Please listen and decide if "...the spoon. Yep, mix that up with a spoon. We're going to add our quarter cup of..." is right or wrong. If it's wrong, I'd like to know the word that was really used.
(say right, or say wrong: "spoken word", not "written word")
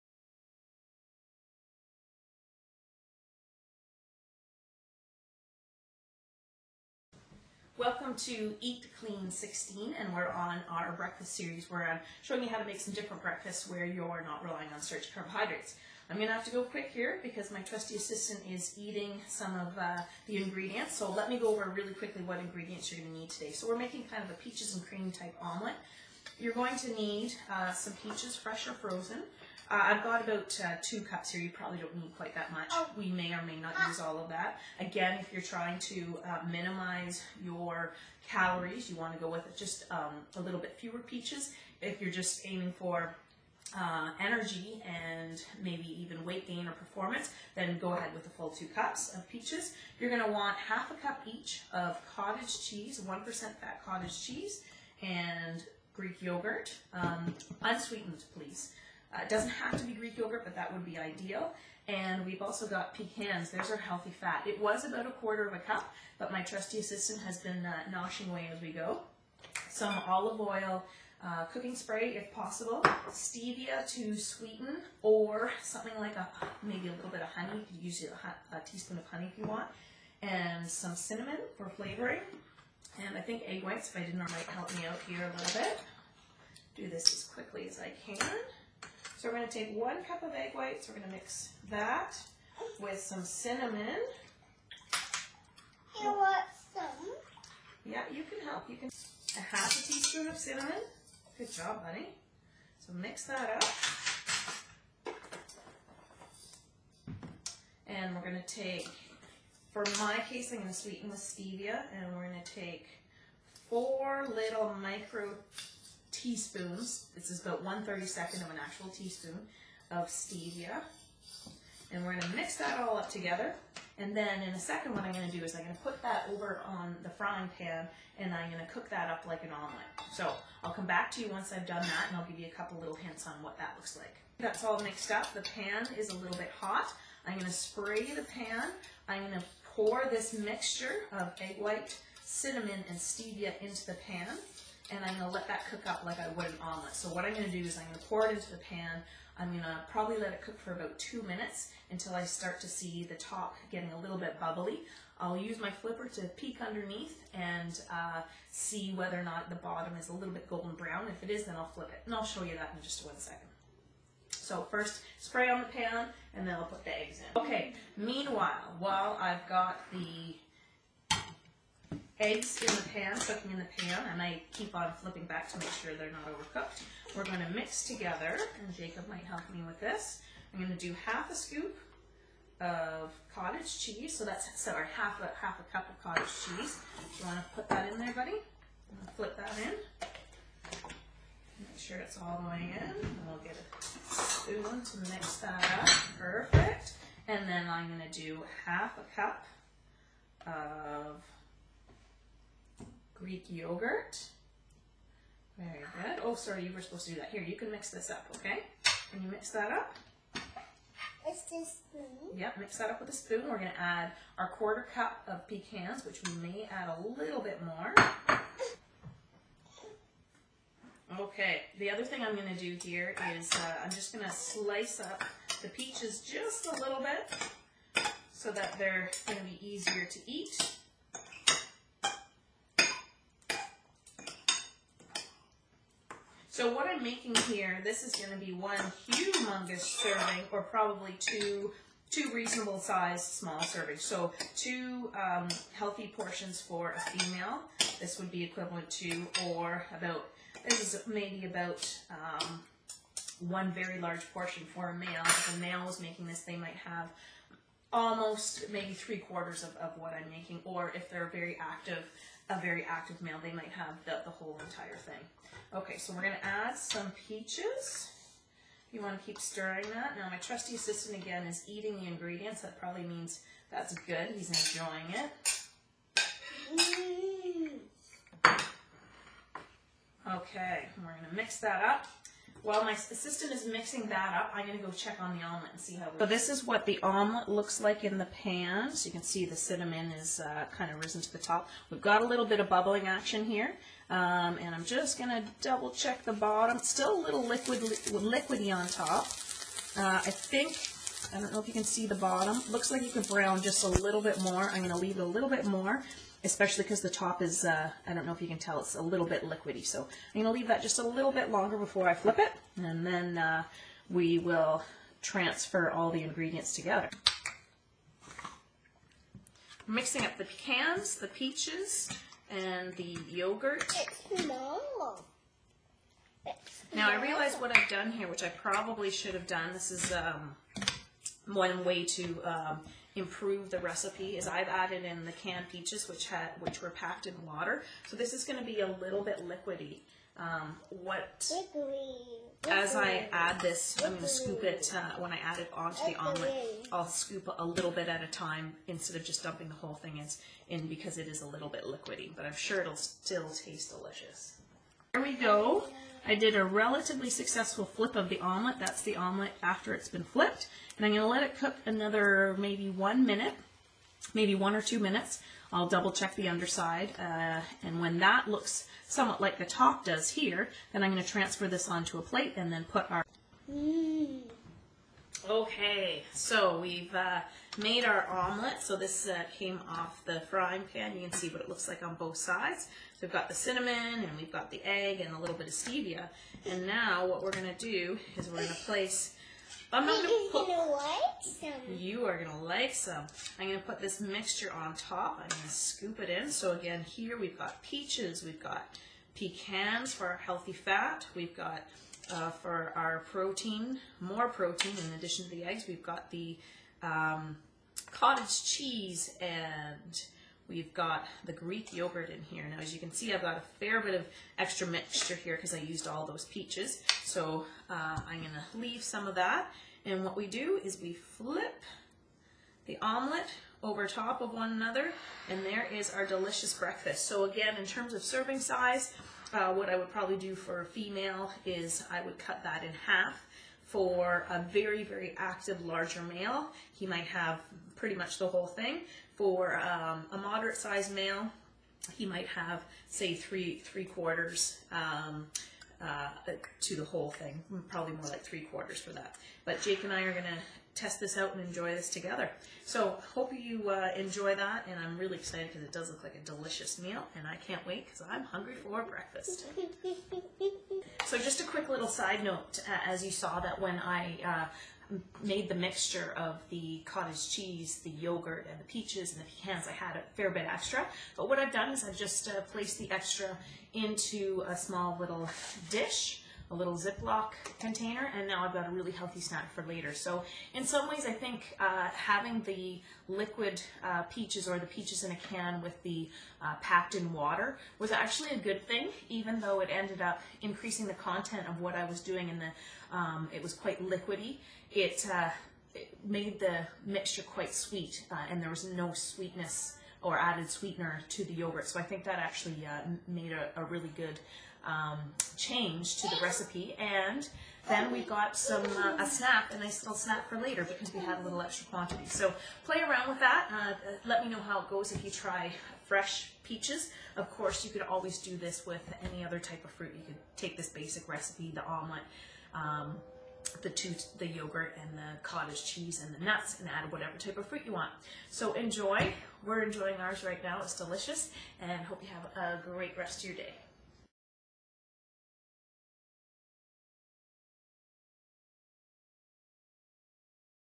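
right.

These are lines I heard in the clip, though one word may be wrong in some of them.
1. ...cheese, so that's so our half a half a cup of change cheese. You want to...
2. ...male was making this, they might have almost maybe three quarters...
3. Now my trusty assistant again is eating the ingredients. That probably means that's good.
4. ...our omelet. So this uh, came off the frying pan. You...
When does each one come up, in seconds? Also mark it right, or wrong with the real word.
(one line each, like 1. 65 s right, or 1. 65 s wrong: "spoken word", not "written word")
1. 183 s wrong: "cottage", not "change"
2. 255 s right
3. 270 s right
4. 378 s right.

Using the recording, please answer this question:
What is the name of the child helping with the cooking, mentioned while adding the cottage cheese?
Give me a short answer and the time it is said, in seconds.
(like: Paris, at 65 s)
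Jacob, at 178 s.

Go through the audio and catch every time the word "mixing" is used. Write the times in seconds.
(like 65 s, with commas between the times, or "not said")
283 s, 319 s.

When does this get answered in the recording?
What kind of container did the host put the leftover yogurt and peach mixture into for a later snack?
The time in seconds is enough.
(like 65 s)
476 s.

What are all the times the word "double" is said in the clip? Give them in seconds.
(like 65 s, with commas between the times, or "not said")
295 s, 365 s.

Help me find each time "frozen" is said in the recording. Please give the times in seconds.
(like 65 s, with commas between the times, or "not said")
28 s.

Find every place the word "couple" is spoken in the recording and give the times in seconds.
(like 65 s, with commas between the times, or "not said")
132 s.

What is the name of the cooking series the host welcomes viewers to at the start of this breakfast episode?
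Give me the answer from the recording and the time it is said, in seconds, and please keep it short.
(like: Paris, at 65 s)
Eat Clean 16, at 8 s.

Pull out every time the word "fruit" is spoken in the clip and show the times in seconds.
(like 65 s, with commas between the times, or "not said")
519 s, 527 s.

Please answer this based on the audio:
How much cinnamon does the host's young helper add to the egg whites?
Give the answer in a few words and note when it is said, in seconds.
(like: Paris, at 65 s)
Half a teaspoon, at 99 s.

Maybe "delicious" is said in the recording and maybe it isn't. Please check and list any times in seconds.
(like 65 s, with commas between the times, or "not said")
353 s, 426 s, 456 s, 530 s.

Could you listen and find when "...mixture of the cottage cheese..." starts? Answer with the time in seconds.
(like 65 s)
465 s.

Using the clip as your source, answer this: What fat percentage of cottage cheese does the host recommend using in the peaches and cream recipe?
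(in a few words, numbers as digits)
1%.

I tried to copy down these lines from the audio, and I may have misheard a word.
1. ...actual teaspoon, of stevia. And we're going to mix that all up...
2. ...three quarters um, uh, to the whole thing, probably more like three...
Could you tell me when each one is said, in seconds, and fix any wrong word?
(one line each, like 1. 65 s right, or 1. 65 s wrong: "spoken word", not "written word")
1. 118 s right
2. 443 s right.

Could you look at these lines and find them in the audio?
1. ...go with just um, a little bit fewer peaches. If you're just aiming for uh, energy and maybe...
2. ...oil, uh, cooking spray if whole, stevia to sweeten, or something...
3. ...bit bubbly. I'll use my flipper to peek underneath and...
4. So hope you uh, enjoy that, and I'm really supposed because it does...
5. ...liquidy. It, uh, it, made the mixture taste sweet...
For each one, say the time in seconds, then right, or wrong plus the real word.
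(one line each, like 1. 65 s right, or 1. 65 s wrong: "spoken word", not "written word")
1. 39 s right
2. 70 s wrong: "possible", not "whole"
3. 154 s right
4. 452 s wrong: "excited", not "supposed"
5. 494 s wrong: "quite", not "taste".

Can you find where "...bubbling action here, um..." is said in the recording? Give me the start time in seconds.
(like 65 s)
292 s.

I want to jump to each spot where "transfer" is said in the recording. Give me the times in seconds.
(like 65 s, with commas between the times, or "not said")
315 s, 371 s.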